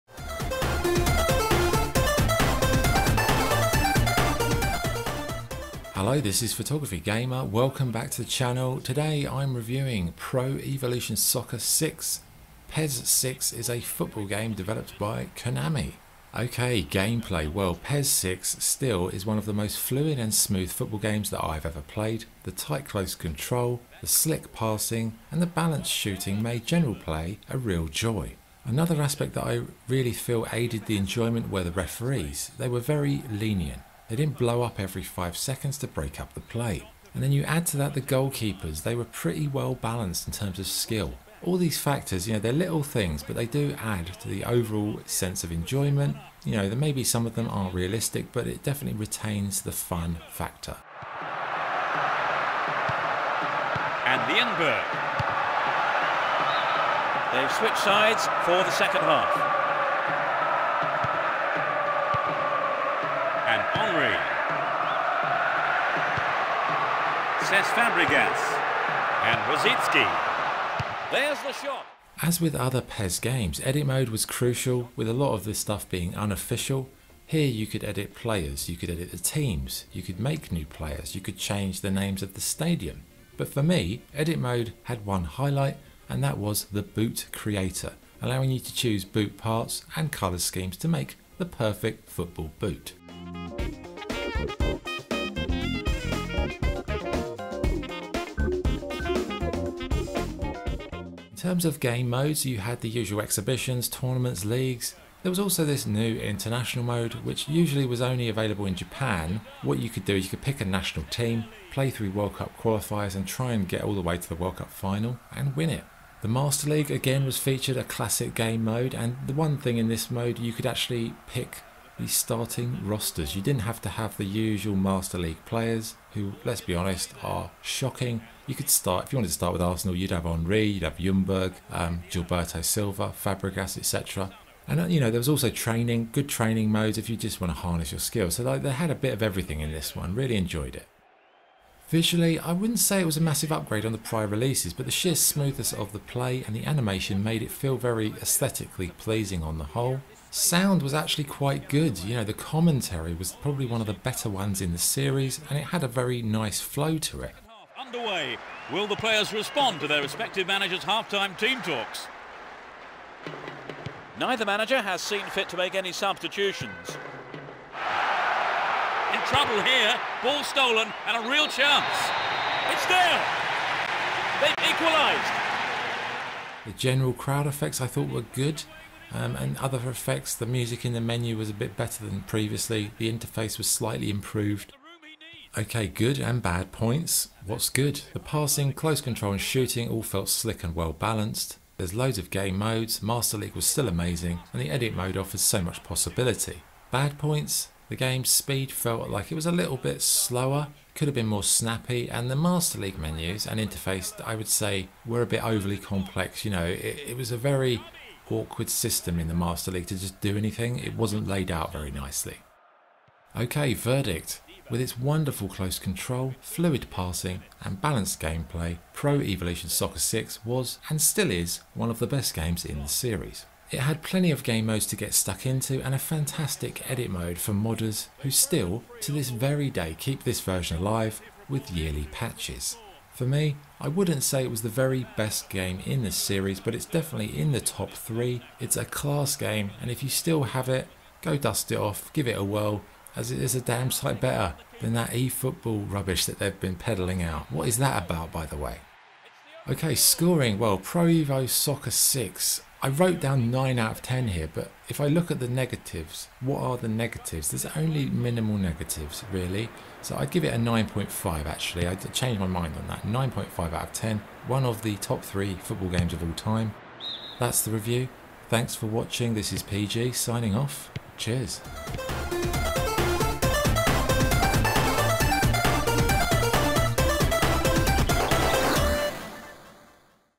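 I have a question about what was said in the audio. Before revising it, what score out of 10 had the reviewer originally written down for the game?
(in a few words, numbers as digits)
9.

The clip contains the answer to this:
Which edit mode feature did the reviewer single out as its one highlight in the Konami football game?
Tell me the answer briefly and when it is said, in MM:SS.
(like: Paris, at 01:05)
Boot creator, at 01:26.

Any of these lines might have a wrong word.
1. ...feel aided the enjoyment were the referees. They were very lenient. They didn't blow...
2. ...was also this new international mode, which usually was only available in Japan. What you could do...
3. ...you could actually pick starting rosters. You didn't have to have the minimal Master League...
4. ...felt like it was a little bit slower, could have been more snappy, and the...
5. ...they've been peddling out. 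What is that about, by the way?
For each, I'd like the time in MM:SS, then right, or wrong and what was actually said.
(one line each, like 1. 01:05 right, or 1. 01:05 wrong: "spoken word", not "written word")
1. 00:30 right
2. 01:45 right
3. 02:00 wrong: "usual", not "minimal"
4. 03:18 right
5. 04:06 right.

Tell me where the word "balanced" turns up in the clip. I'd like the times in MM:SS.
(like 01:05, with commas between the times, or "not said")
00:25, 00:39, 03:10, 03:37.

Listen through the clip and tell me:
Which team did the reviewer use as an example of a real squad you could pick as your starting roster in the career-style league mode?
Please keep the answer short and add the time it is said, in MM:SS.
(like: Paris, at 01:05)
Arsenal, at 02:09.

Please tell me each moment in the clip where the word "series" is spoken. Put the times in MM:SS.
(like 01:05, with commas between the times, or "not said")
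02:34, 03:42, 03:56.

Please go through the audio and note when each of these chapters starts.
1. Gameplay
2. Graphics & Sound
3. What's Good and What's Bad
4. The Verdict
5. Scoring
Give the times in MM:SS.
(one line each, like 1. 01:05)
1. 00:15
2. 02:21
3. 03:05
4. 03:33
5. 04:09.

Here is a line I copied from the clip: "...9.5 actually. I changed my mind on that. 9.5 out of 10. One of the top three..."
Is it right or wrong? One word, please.
right.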